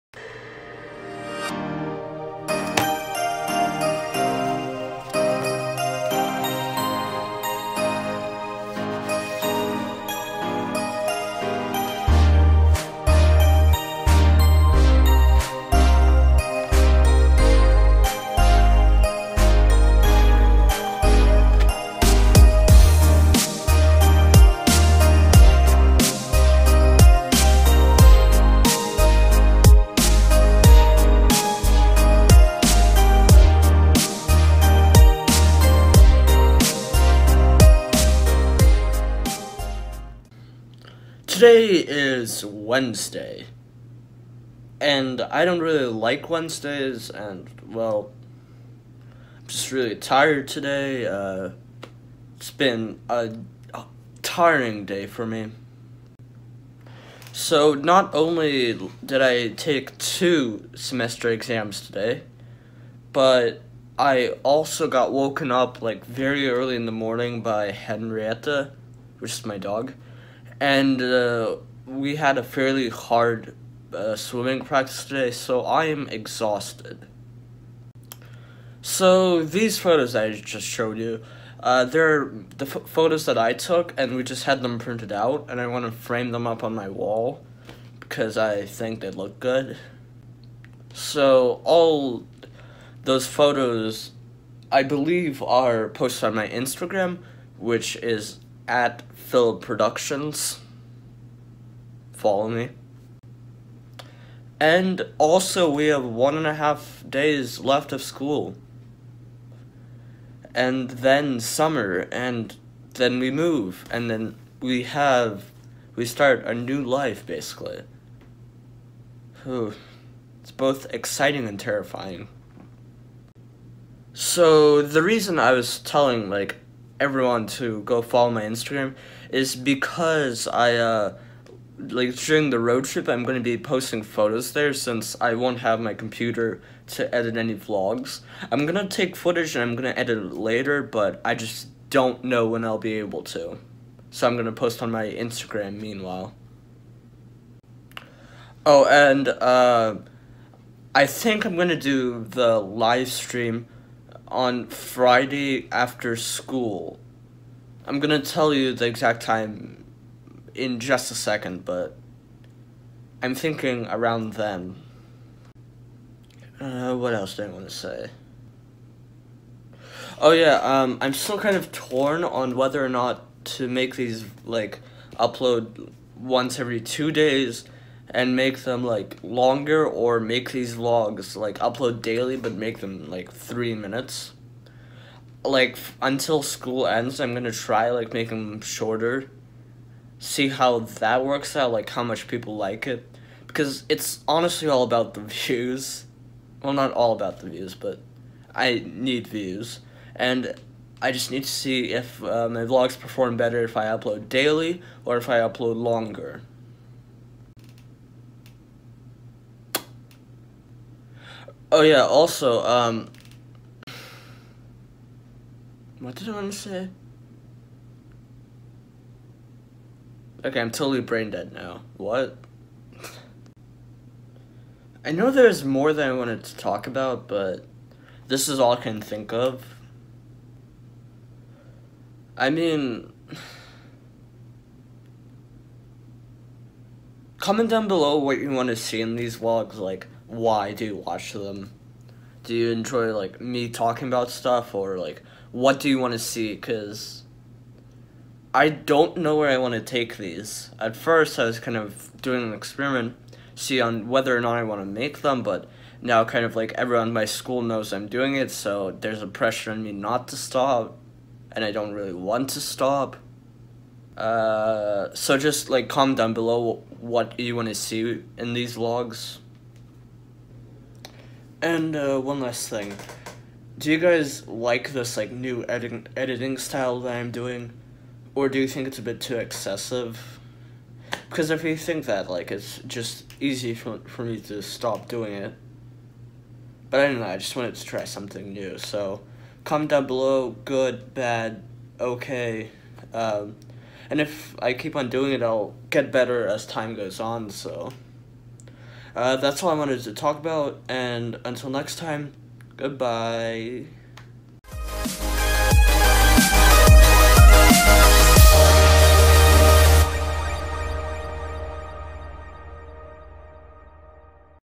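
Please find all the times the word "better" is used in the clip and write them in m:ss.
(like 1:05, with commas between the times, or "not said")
3:23, 4:56.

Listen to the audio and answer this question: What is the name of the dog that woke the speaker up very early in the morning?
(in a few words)
Henrietta.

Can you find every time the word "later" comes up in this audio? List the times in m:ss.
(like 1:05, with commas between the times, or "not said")
2:20.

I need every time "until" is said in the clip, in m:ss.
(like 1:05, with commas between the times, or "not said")
3:06, 5:01.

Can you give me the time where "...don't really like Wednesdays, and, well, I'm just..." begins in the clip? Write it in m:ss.
0:45.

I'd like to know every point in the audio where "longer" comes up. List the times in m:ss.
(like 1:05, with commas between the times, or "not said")
2:59, 3:25.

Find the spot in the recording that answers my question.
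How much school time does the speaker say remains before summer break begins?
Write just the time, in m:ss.
1:46.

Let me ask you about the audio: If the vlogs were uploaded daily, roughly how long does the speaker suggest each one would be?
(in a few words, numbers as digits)
3 minutes.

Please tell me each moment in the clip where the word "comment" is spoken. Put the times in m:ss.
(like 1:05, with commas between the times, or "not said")
3:57, 4:25, 4:49.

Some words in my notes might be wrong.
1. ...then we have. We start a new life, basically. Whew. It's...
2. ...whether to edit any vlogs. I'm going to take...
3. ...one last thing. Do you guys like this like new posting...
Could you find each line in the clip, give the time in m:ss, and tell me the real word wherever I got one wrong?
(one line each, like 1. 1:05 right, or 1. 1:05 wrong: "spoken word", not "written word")
1. 1:54 right
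2. 2:15 wrong: "computer", not "whether"
3. 4:32 wrong: "editing", not "posting".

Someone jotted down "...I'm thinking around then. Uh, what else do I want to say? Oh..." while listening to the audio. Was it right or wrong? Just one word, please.
right.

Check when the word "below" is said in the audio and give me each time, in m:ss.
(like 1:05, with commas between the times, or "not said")
3:57, 4:26, 4:50.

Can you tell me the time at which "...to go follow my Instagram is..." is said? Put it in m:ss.
2:07.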